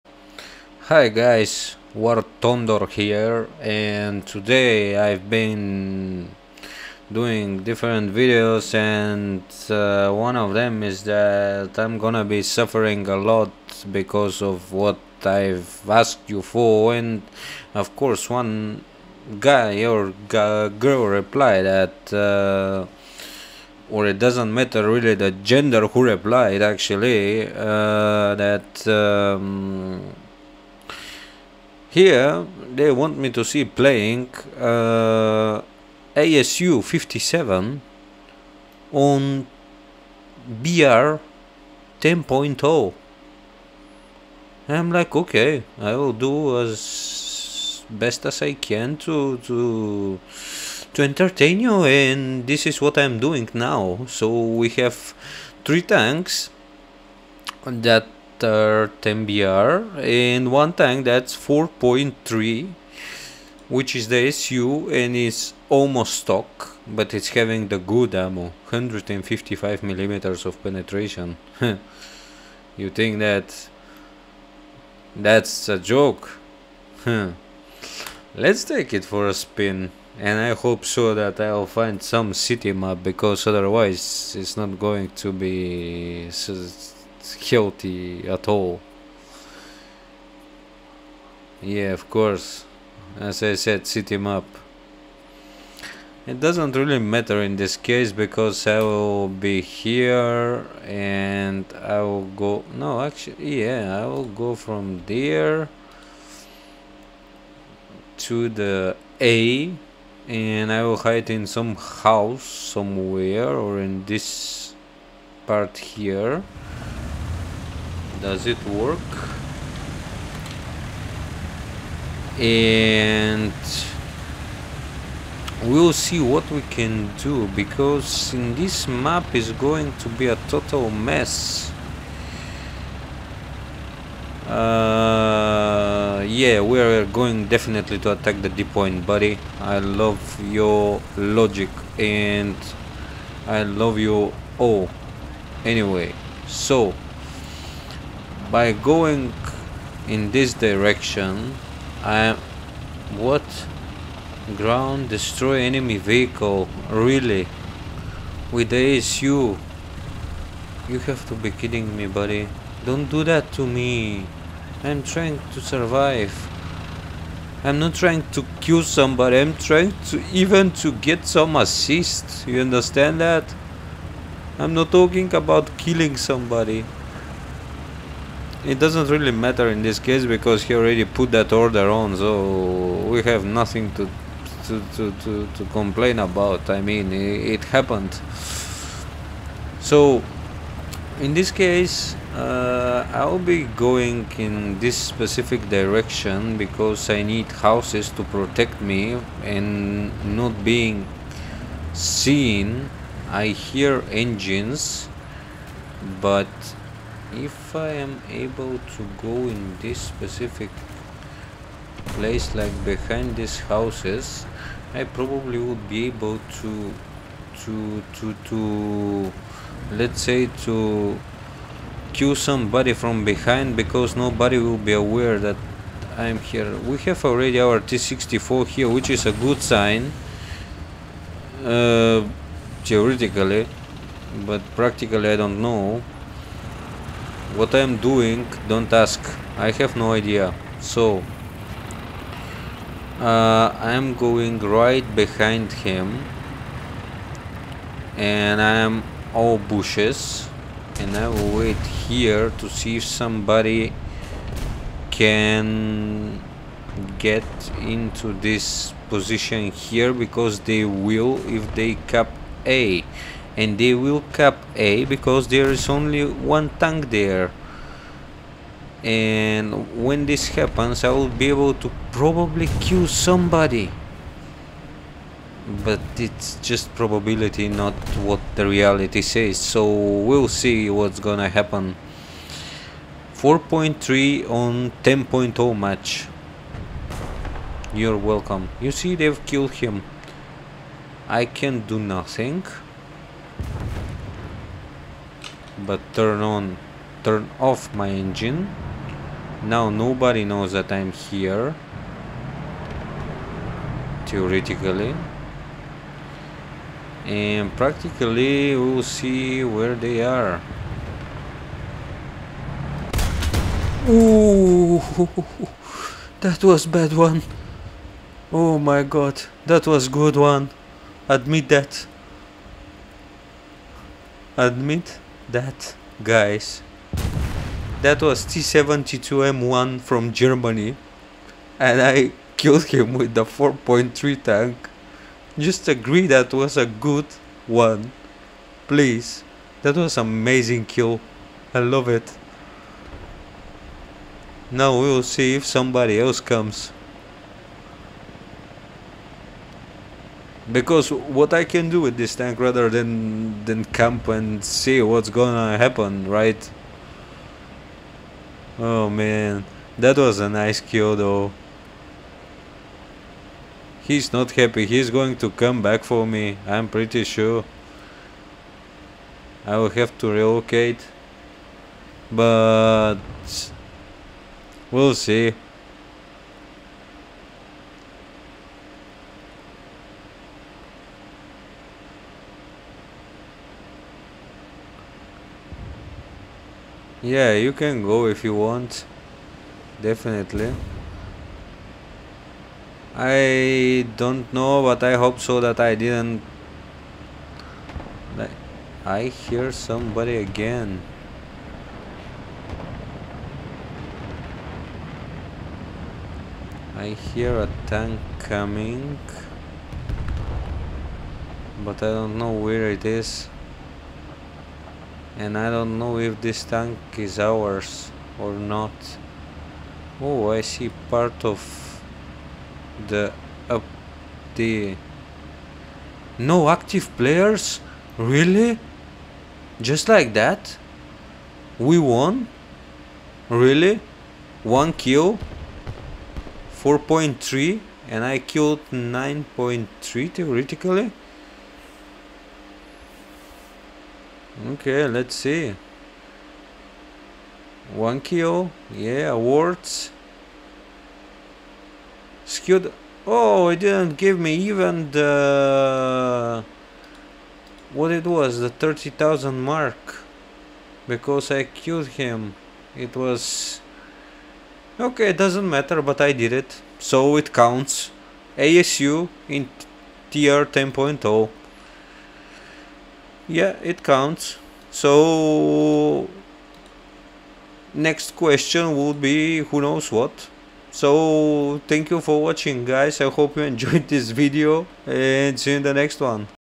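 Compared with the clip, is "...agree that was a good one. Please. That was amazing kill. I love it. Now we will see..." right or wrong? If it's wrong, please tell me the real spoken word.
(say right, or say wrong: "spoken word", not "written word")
right.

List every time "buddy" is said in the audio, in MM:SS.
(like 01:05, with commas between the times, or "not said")
02:19, 02:42.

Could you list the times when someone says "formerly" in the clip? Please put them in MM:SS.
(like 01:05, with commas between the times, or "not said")
not said.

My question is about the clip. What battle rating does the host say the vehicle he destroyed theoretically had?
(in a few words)
9.3.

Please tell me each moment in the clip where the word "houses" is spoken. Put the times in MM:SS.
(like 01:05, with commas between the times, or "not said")
01:51, 03:17, 03:33.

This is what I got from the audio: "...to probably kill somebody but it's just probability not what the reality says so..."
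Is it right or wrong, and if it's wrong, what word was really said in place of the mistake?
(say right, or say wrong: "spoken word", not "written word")
right.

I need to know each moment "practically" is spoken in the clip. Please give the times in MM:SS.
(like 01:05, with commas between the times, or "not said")
03:54, 05:07.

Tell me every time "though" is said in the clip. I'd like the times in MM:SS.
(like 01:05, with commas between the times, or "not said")
06:01.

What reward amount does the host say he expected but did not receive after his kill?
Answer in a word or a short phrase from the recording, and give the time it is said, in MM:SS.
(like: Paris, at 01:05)
30,000, at 07:38.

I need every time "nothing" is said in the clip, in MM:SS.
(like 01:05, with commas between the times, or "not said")
03:03, 04:51.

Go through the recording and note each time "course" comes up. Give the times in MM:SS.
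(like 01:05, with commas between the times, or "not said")
00:17, 01:32.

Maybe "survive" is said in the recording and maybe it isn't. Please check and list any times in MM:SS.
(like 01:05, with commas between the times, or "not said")
02:45.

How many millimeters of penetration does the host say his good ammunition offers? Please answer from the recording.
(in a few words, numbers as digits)
155.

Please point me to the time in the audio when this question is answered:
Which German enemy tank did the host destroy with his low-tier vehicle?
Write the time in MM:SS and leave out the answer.
05:28.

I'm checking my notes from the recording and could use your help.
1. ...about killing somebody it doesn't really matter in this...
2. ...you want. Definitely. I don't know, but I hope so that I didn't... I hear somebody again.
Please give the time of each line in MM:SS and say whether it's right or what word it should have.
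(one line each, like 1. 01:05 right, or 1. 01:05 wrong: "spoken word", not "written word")
1. 02:55 right
2. 06:28 right.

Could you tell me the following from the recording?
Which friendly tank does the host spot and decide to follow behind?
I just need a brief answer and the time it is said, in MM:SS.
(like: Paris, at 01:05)
T64, at 03:47.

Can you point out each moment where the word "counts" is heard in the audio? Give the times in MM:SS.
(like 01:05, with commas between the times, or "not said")
07:47, 07:54.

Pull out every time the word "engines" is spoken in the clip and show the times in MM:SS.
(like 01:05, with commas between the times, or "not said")
03:24, 04:58.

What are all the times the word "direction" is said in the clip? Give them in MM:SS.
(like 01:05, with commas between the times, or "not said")
02:30, 03:15.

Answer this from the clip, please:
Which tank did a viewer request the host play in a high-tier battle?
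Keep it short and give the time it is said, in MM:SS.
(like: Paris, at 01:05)
ASU 57, at 00:36.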